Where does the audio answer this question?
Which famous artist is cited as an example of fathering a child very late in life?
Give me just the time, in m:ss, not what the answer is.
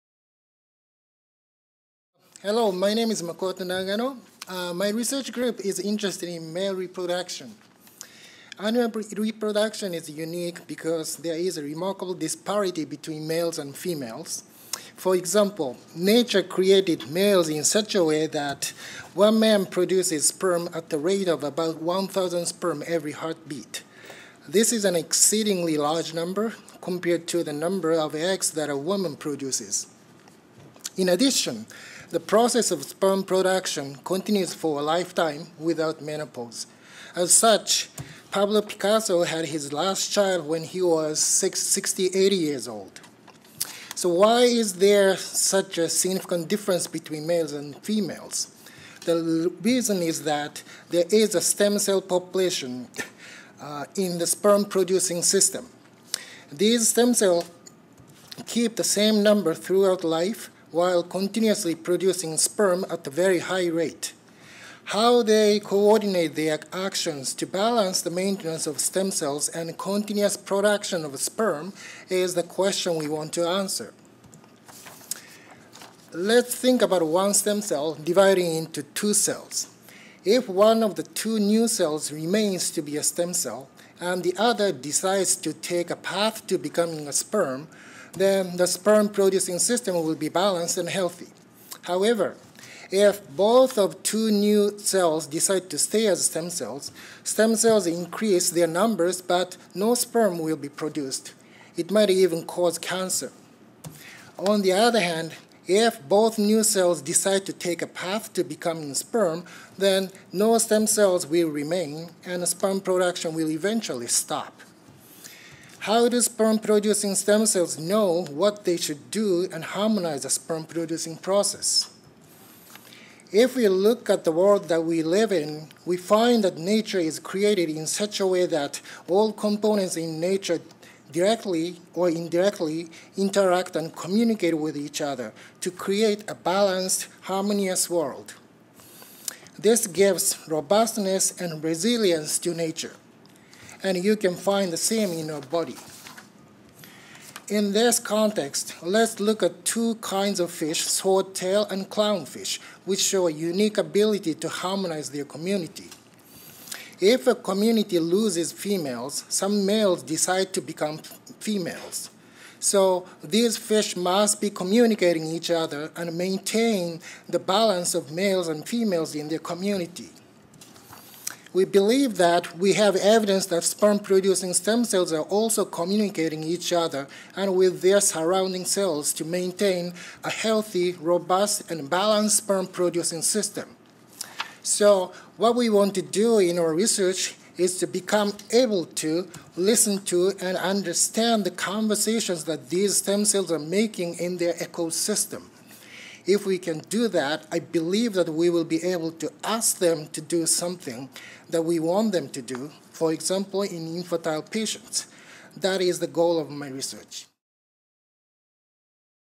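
0:38.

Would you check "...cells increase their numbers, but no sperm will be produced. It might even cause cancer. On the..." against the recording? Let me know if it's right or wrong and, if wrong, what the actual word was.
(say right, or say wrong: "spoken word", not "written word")
right.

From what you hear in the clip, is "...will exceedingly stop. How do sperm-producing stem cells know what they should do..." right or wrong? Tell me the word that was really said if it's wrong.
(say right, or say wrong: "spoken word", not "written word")
wrong: "eventually", not "exceedingly".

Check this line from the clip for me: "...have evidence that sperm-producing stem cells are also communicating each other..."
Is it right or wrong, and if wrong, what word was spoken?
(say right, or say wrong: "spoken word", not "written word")
right.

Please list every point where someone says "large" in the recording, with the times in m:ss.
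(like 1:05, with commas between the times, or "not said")
0:25.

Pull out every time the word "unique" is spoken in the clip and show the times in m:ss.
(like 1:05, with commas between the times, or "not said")
0:10, 2:33.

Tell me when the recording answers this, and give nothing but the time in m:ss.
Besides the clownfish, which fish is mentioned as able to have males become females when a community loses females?
2:30.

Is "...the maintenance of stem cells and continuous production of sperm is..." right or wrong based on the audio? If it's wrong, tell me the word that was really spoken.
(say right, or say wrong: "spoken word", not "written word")
right.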